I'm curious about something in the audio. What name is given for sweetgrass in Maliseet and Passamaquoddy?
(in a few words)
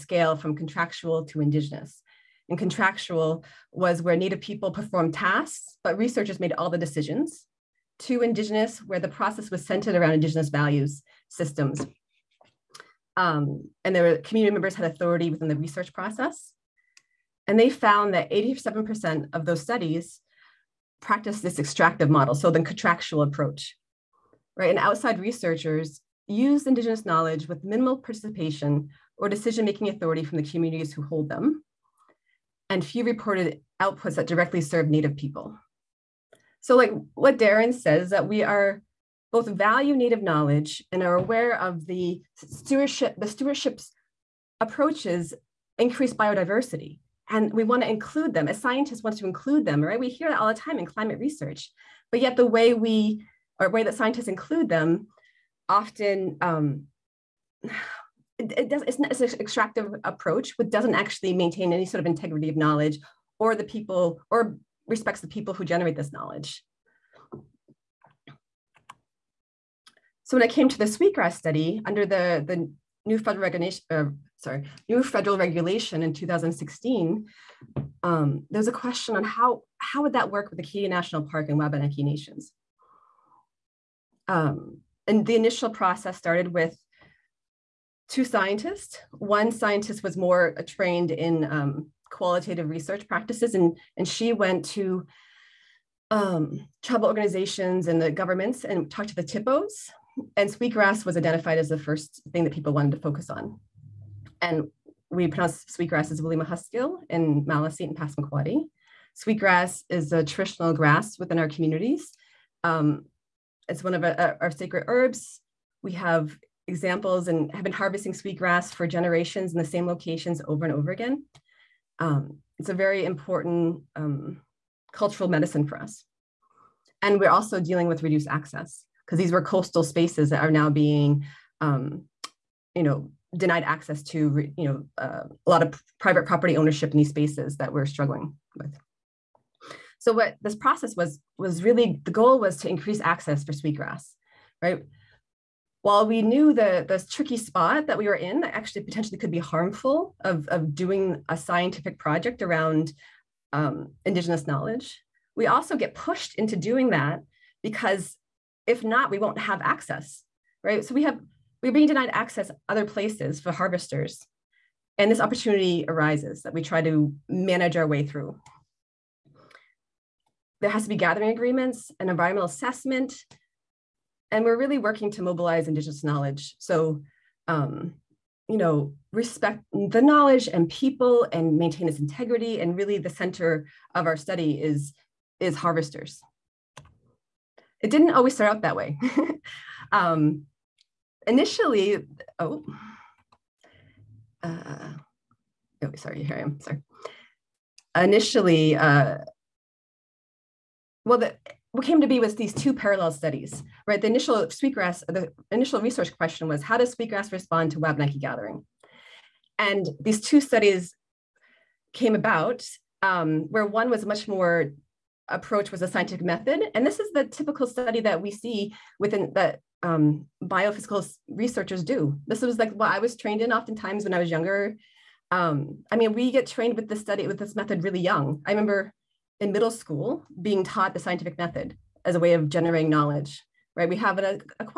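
Wilima Huskill.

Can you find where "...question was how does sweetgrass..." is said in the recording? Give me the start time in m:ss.
3:26.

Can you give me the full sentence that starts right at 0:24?
And outside researchers used Indigenous knowledge with minimal participation or decision-making authority from the communities who hold them.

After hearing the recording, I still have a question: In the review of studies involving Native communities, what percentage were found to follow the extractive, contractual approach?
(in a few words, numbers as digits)
87%.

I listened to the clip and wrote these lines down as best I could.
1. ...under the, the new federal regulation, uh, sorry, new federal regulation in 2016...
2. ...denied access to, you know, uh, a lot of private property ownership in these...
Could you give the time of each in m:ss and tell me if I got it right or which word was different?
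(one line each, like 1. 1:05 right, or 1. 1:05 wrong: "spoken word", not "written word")
1. 1:11 right
2. 2:13 right.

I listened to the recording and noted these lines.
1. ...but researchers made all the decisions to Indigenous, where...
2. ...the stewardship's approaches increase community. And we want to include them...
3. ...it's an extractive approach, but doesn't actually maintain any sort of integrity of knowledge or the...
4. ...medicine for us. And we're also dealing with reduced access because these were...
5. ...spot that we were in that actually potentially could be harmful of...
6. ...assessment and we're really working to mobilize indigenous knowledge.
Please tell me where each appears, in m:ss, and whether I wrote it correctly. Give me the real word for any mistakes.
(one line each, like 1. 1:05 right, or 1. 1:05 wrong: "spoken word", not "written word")
1. 0:05 right
2. 0:43 wrong: "biodiversity", not "community"
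3. 0:59 right
4. 2:05 right
5. 2:27 right
6. 2:52 right.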